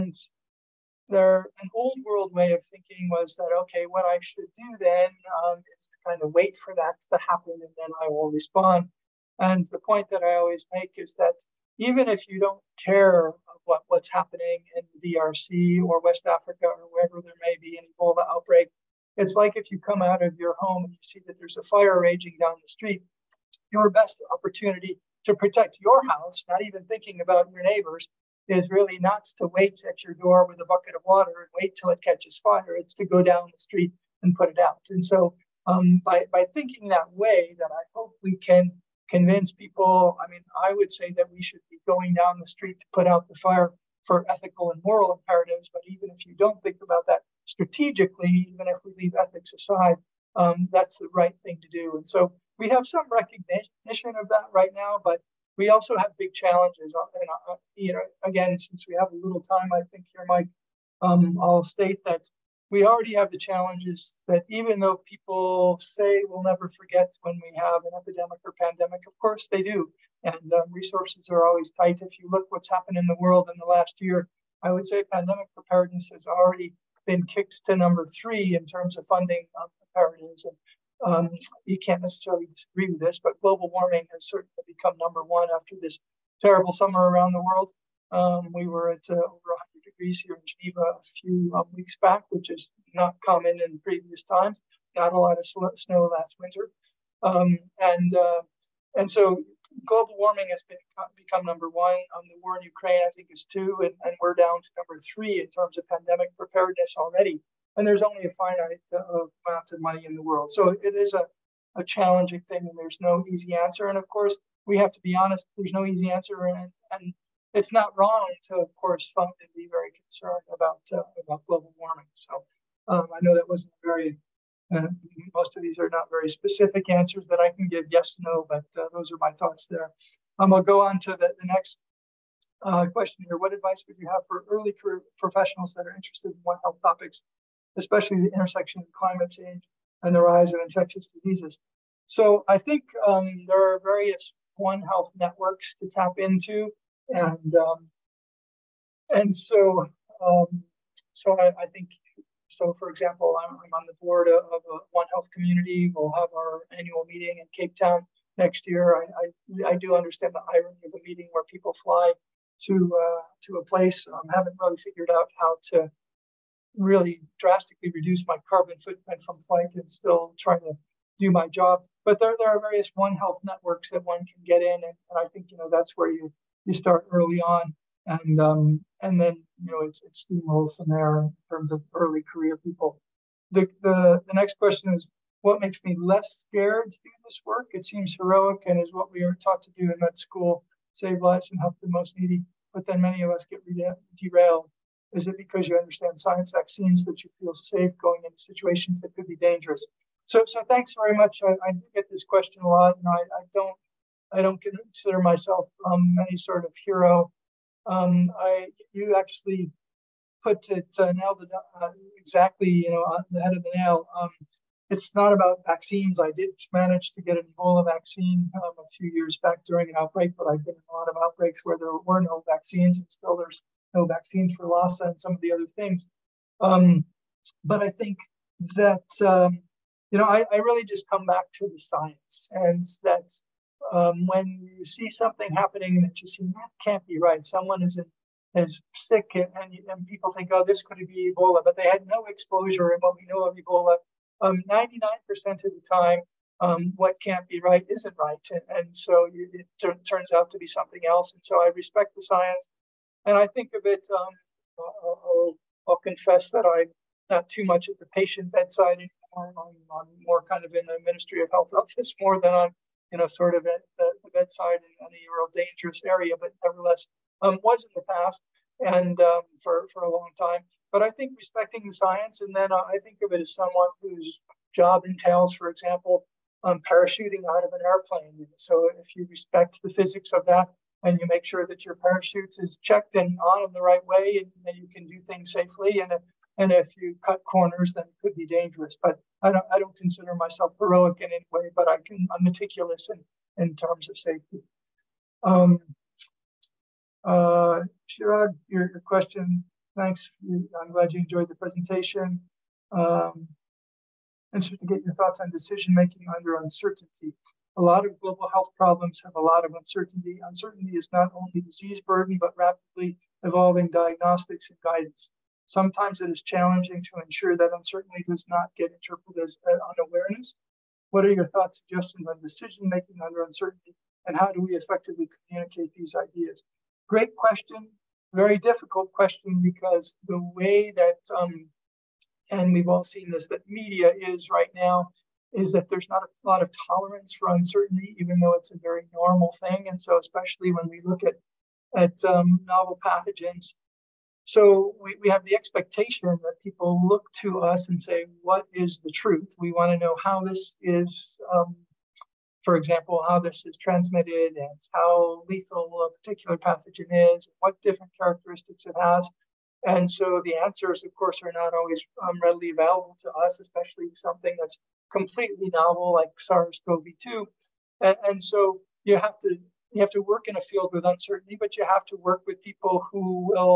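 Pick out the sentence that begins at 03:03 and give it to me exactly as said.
The, the the next question is what makes me less scared to do this work?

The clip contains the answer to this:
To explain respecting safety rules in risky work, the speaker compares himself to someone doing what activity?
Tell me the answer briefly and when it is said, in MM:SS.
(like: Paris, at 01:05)
parachuting out of an airplane, at 04:36.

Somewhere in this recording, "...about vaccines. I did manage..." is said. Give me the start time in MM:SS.
03:35.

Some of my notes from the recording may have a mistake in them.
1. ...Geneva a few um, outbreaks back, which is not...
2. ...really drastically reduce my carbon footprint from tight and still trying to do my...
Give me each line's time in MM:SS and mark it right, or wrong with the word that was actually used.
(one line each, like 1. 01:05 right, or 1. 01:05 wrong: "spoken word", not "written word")
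1. 01:30 wrong: "weeks", not "outbreaks"
2. 02:46 wrong: "flight", not "tight".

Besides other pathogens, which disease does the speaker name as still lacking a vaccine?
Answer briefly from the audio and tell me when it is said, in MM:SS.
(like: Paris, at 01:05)
Lassa, at 03:44.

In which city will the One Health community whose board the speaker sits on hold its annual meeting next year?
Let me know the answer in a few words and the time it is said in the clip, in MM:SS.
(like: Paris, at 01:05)
Cape Town, at 02:37.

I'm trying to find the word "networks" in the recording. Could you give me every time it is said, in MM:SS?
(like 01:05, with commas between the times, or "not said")
02:25, 02:53.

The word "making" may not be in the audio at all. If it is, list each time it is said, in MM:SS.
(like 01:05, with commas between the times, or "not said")
05:05, 05:22.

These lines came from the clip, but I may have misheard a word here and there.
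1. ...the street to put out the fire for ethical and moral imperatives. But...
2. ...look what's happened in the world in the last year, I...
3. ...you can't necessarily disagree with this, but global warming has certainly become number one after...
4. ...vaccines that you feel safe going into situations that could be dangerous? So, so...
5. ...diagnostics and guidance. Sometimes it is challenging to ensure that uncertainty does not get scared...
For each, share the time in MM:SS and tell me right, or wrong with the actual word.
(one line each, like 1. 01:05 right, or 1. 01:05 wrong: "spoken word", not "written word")
1. 00:42 right
2. 01:12 right
3. 01:21 right
4. 03:16 right
5. 05:13 wrong: "interpreted", not "scared".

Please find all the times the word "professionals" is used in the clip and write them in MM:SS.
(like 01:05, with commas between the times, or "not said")
02:15.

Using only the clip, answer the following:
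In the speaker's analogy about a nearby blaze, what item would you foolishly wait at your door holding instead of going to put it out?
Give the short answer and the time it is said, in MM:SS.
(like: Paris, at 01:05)
bucket of water, at 00:30.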